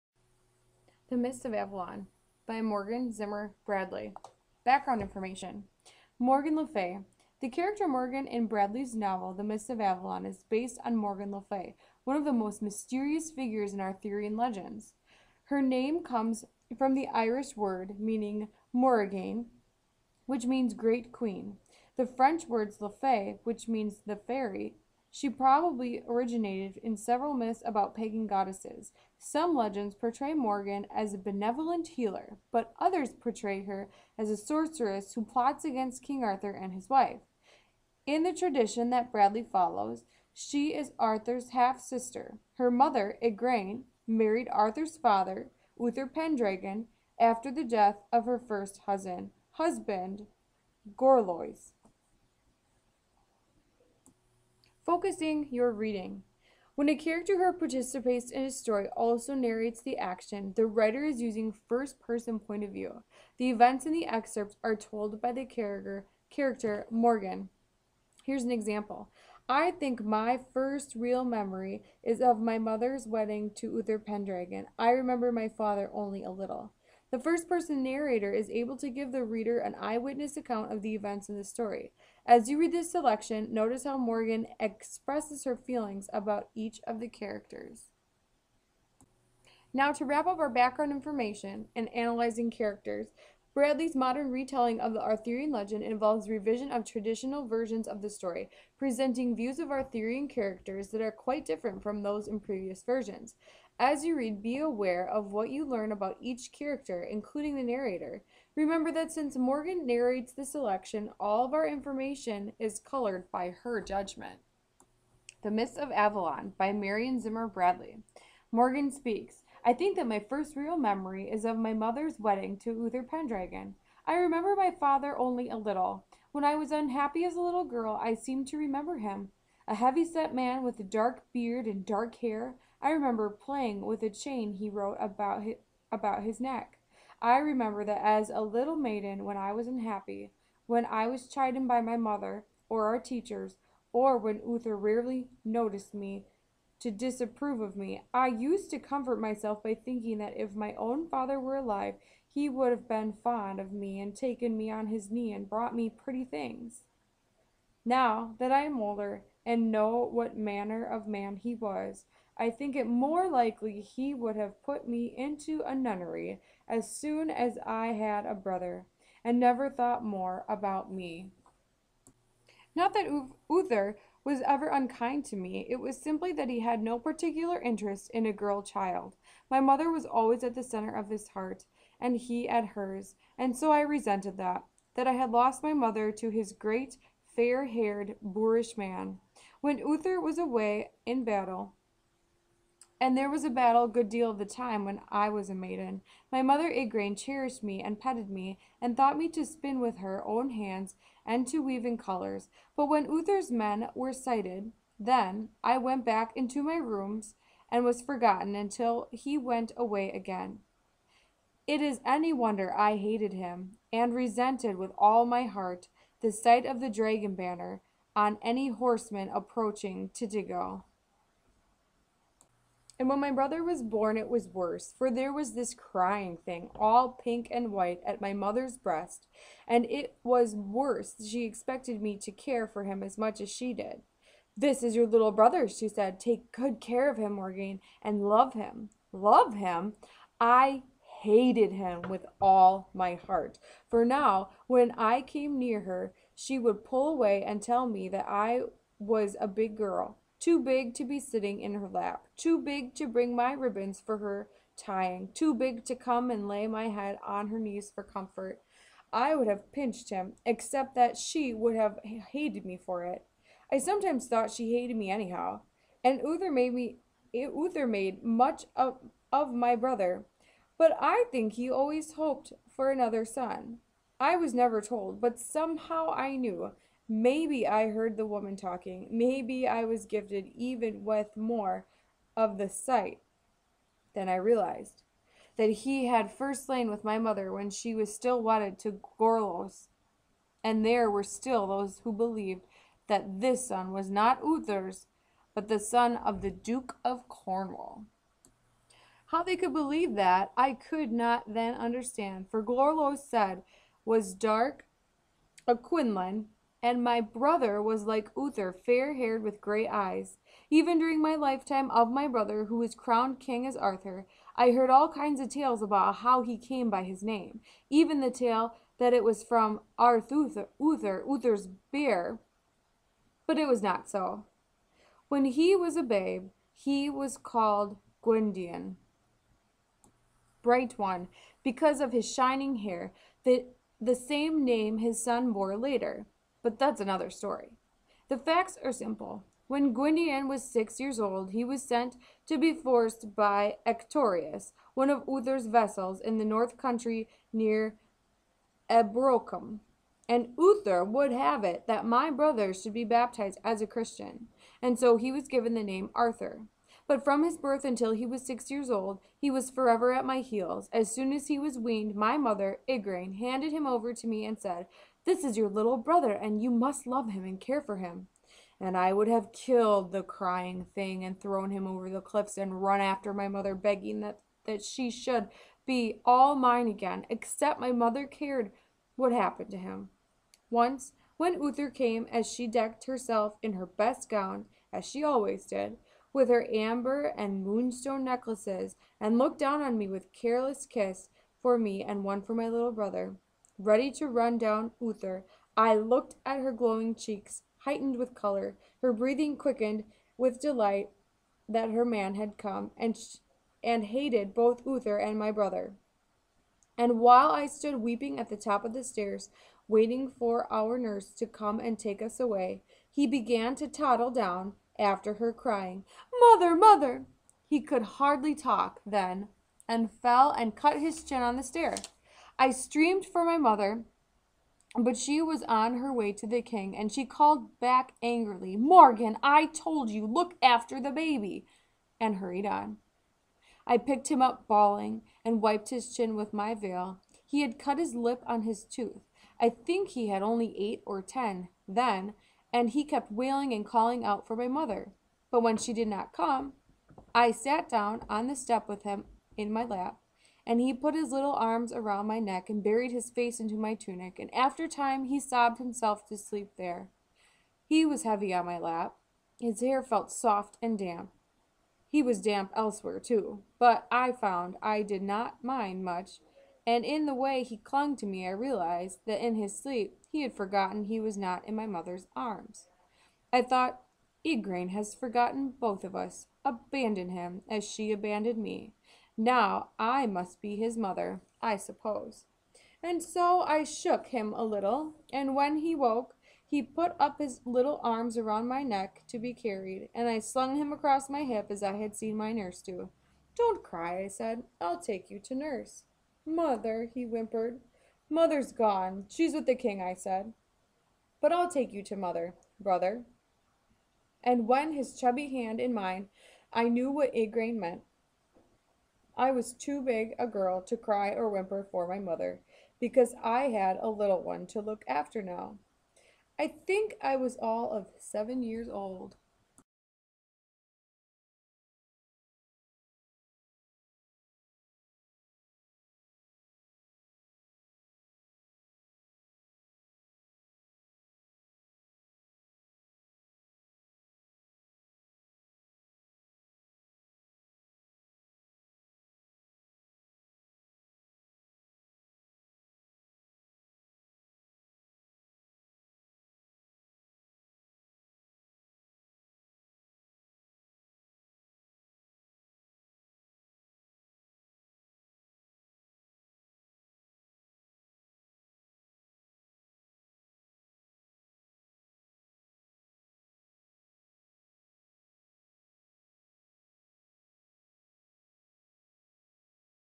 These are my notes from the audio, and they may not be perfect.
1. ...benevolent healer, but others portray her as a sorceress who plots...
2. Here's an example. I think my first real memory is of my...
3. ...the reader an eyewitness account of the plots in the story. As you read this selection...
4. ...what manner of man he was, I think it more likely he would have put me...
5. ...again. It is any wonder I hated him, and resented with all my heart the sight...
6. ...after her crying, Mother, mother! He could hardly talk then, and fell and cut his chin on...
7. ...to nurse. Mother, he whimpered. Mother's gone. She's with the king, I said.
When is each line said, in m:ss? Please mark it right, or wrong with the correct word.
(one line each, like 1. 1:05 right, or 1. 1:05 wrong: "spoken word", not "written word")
1. 0:31 right
2. 1:08 right
3. 1:19 wrong: "events", not "plots"
4. 2:40 right
5. 3:30 right
6. 6:54 right
7. 8:15 right.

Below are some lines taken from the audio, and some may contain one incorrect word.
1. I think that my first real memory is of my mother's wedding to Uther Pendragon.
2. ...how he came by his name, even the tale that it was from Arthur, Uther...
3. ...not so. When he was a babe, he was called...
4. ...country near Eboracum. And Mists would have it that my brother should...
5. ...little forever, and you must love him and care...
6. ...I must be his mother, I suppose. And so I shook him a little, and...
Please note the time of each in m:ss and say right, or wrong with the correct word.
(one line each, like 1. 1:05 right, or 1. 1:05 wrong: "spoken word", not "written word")
1. 1:59 right
2. 5:16 right
3. 5:23 right
4. 5:46 wrong: "Uther", not "Mists"
5. 6:05 wrong: "brother", not "forever"
6. 7:59 right.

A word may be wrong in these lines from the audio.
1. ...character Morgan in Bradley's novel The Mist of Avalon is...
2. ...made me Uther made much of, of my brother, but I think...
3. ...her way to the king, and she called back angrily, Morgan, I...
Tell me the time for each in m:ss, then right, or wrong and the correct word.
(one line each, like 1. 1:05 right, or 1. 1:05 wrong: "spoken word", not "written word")
1. 0:07 right
2. 4:26 right
3. 7:05 right.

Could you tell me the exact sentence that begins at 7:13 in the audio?
I picked him up bawling and wiped his chin with my veil.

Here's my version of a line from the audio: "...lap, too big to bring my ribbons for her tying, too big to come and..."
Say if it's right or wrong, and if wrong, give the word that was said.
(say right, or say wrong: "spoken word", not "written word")
right.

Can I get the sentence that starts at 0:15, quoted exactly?
Her name comes from the Irish word meaning Morrigan, which means Great Queen.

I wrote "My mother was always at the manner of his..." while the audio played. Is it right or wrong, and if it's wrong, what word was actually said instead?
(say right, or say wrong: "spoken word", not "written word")
wrong: "center", not "manner".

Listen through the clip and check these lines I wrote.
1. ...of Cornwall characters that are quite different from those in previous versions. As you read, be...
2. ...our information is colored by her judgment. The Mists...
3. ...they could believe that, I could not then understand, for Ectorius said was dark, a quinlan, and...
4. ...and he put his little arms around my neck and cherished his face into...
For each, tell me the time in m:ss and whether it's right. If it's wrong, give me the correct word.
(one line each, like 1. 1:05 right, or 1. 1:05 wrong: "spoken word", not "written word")
1. 1:39 wrong: "Arthurian", not "Cornwall"
2. 1:51 right
3. 4:59 wrong: "Gorlois", not "Ectorius"
4. 7:30 wrong: "buried", not "cherished".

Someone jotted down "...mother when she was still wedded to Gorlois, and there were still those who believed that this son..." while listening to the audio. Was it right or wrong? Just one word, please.
right.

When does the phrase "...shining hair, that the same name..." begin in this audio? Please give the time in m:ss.
5:32.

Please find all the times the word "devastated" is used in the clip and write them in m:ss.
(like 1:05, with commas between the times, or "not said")
not said.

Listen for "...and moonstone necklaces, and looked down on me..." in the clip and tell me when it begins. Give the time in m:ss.
6:27.